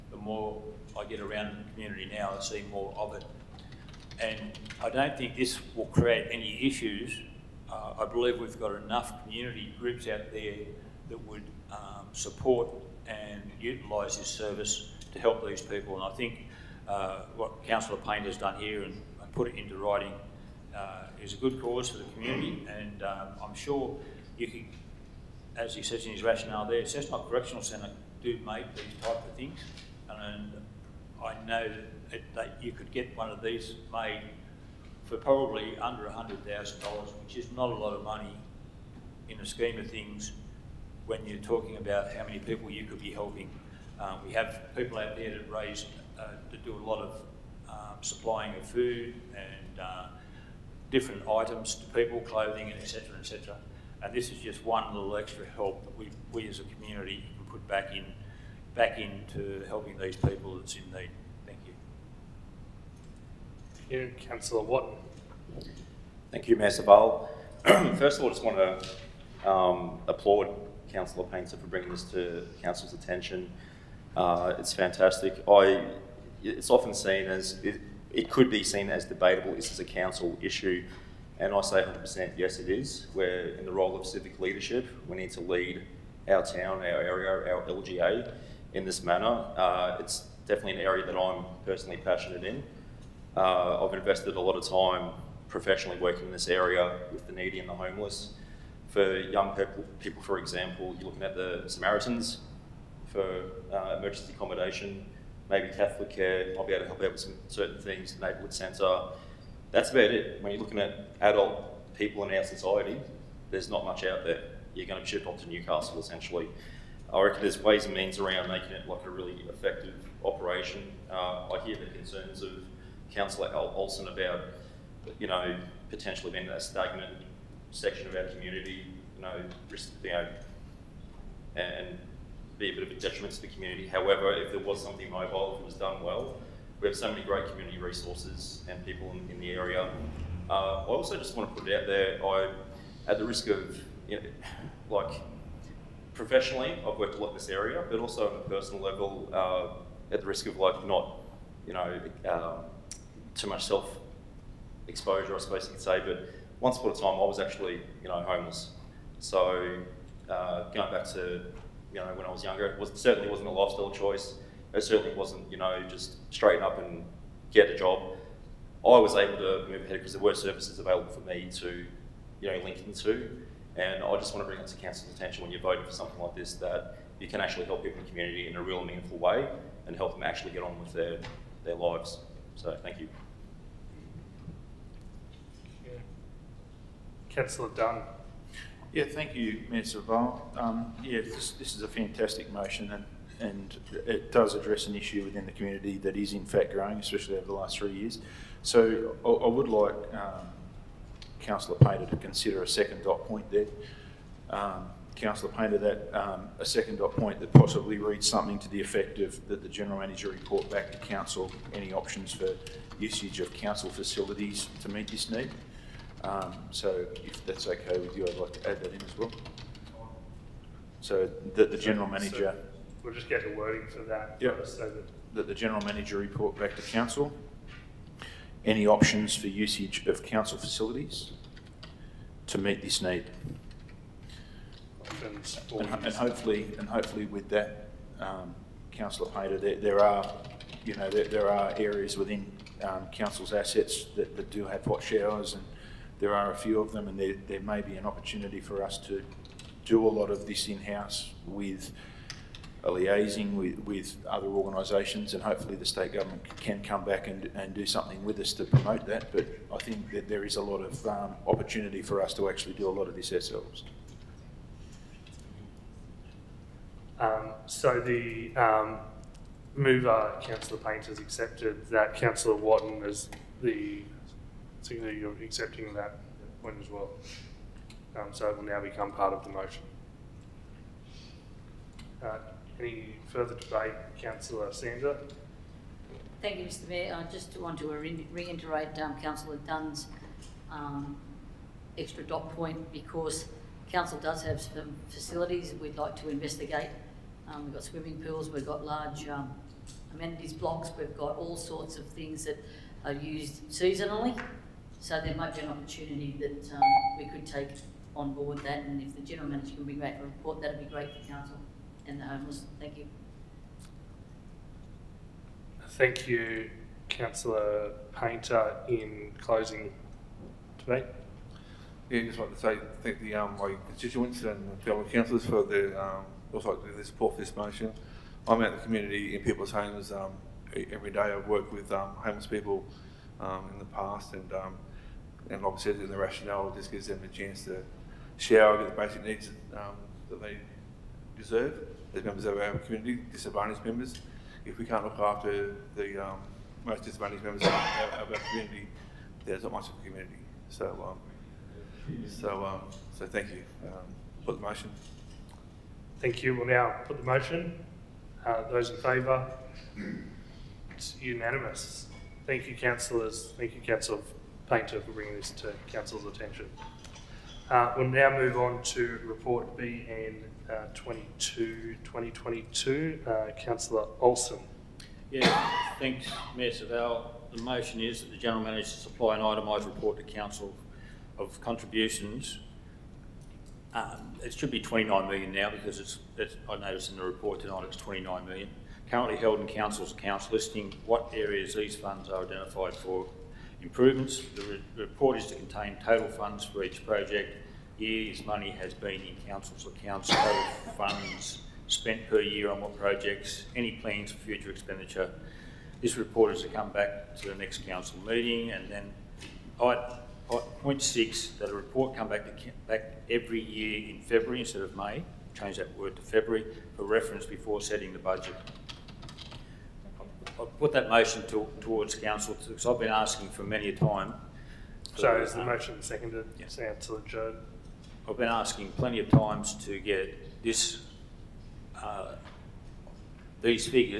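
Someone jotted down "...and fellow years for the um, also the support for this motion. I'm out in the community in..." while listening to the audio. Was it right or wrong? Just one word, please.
wrong.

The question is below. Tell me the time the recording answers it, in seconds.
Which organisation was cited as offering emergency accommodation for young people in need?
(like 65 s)
101 s.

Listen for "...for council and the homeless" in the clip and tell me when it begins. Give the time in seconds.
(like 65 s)
311 s.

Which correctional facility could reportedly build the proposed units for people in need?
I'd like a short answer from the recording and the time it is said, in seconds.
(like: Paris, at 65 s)
Cessnock Correctional Centre, at 26 s.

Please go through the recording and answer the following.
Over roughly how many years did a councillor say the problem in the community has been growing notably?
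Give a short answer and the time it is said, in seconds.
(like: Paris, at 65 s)
3, at 197 s.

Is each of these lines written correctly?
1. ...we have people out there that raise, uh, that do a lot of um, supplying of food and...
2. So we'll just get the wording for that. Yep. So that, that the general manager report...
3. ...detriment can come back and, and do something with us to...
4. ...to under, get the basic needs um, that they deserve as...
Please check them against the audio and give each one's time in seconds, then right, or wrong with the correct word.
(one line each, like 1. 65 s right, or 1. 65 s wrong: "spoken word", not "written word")
1. 44 s right
2. 222 s right
3. 256 s wrong: "government", not "detriment"
4. 337 s wrong: "shower", not "under".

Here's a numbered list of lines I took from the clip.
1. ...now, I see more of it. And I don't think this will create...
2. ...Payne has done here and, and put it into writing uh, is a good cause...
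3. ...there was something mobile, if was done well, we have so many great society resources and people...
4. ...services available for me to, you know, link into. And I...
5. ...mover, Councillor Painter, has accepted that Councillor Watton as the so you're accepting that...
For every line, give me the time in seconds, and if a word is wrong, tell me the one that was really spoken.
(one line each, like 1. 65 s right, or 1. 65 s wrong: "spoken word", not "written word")
1. 2 s right
2. 17 s right
3. 134 s wrong: "community", not "society"
4. 170 s right
5. 269 s right.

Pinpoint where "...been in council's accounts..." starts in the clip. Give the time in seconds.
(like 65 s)
398 s.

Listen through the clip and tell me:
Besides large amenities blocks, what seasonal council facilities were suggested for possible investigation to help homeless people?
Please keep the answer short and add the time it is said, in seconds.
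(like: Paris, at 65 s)
swimming pools, at 297 s.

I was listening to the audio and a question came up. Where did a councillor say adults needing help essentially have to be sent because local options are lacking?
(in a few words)
Newcastle.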